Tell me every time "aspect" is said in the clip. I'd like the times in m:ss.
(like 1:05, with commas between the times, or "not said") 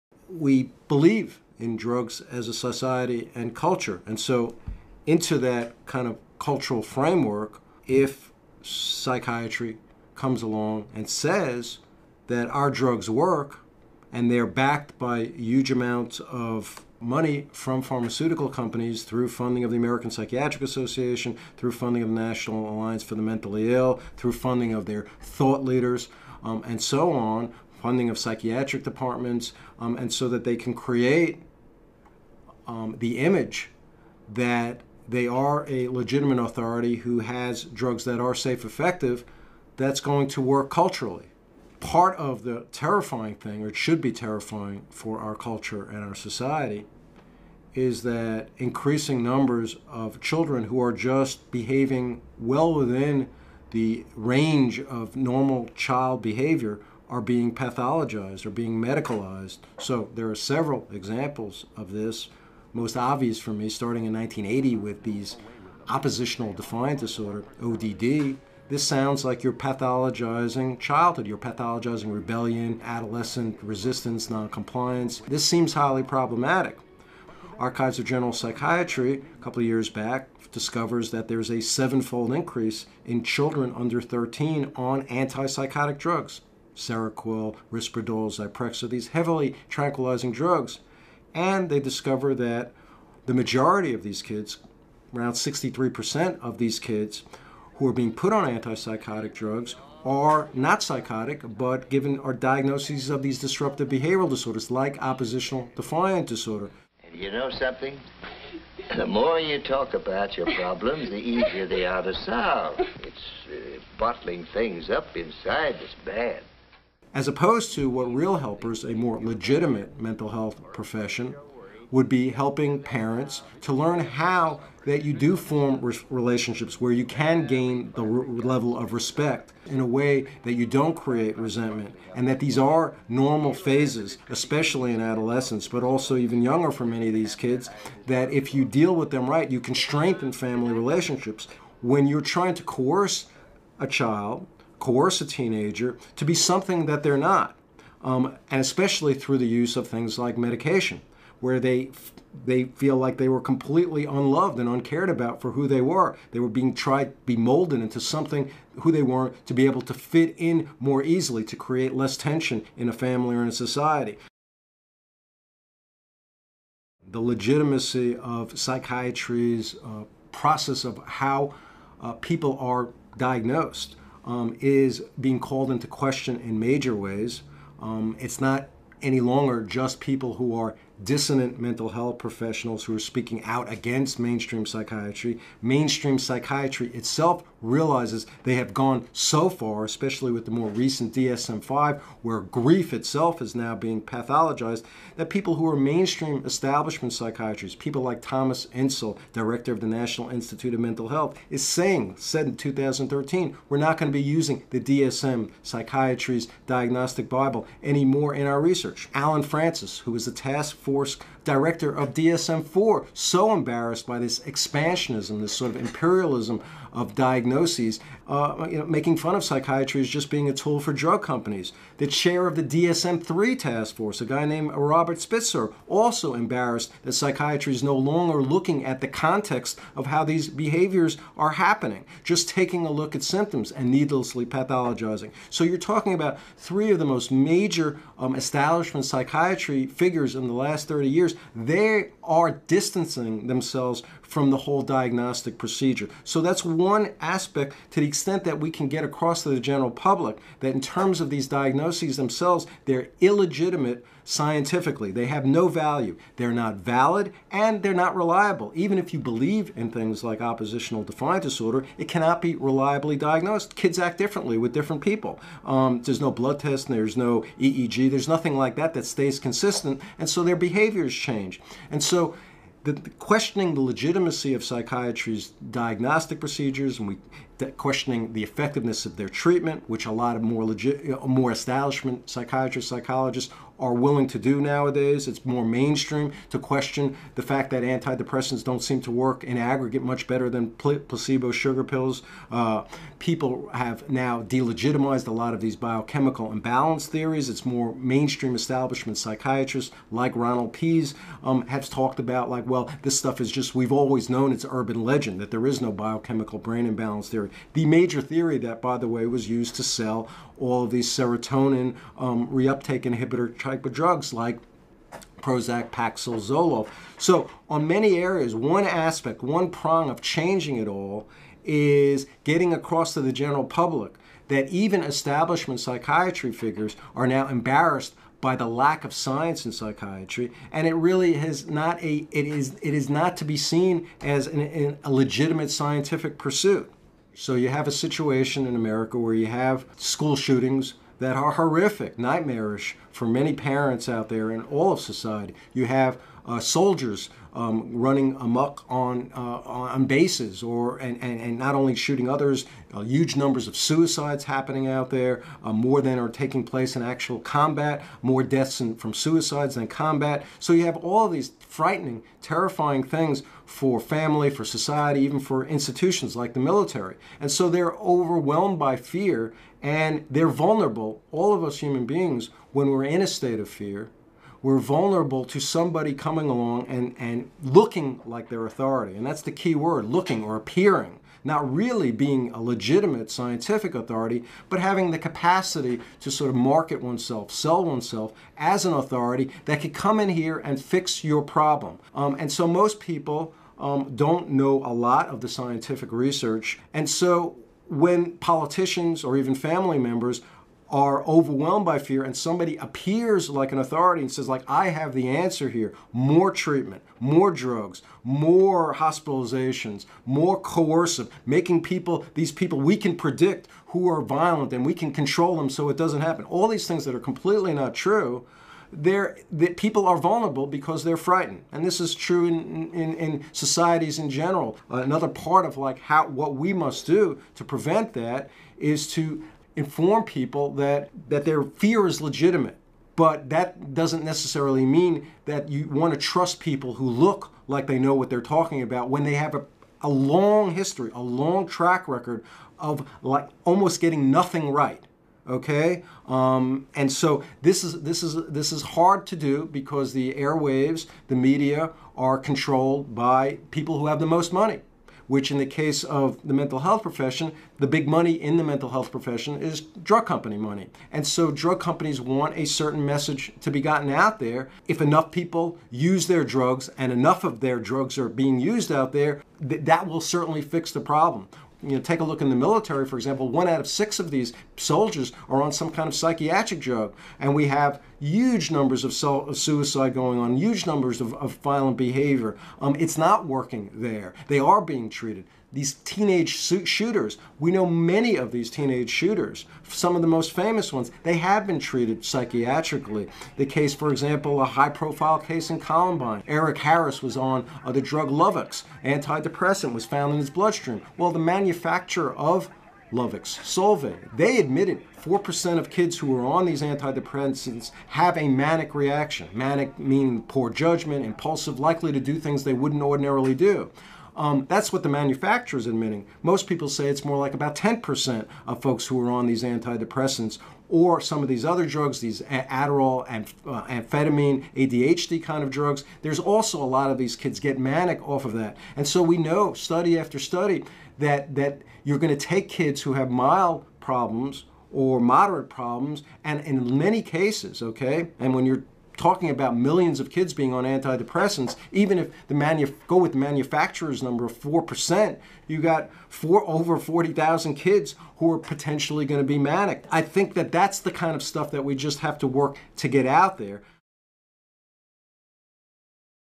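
4:07, 5:18.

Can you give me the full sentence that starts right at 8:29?
Manic meaning poor judgment, impulsive, likely to do things they wouldn't ordinarily do.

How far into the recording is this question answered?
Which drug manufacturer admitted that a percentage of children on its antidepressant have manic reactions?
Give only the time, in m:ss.
8:23.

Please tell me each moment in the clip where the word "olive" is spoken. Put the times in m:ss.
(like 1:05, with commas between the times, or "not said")
not said.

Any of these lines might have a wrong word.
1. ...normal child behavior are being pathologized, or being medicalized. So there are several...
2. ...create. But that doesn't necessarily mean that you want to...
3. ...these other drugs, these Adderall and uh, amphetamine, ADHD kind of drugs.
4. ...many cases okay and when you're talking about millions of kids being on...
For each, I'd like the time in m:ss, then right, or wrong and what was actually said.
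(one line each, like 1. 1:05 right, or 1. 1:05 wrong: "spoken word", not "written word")
1. 0:55 right
2. 7:12 wrong: "legitimate", not "create"
3. 8:41 right
4. 8:56 right.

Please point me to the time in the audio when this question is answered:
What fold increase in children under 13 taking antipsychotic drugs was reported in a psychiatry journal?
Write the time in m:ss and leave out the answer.
1:21.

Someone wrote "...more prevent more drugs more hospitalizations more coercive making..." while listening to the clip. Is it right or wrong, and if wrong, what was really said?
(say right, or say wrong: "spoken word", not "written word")
wrong: "treatment", not "prevent".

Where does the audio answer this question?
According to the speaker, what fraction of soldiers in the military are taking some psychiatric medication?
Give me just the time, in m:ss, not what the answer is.
7:53.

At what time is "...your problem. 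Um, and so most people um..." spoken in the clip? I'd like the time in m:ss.
6:31.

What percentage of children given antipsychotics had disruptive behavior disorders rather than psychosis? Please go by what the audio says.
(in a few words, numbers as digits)
63%.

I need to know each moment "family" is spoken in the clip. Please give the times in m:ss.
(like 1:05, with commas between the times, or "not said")
2:20, 2:42, 6:03, 6:39.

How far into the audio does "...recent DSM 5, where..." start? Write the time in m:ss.
3:10.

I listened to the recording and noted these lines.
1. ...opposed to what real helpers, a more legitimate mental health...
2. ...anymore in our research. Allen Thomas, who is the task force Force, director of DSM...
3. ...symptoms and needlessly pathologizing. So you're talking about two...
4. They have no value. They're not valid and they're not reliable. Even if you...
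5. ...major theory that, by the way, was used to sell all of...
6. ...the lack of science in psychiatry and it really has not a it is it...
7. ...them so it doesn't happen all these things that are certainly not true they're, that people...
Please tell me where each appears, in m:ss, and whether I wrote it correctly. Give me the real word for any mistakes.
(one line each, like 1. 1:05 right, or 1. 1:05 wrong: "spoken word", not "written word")
1. 1:57 right
2. 3:27 wrong: "Frances", not "Thomas"
3. 3:53 wrong: "three", not "two"
4. 4:15 right
5. 5:07 right
6. 5:28 right
7. 6:55 wrong: "completely", not "certainly".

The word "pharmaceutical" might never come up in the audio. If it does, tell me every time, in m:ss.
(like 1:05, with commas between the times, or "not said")
0:17.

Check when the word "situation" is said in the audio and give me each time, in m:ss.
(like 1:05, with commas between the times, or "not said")
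5:37.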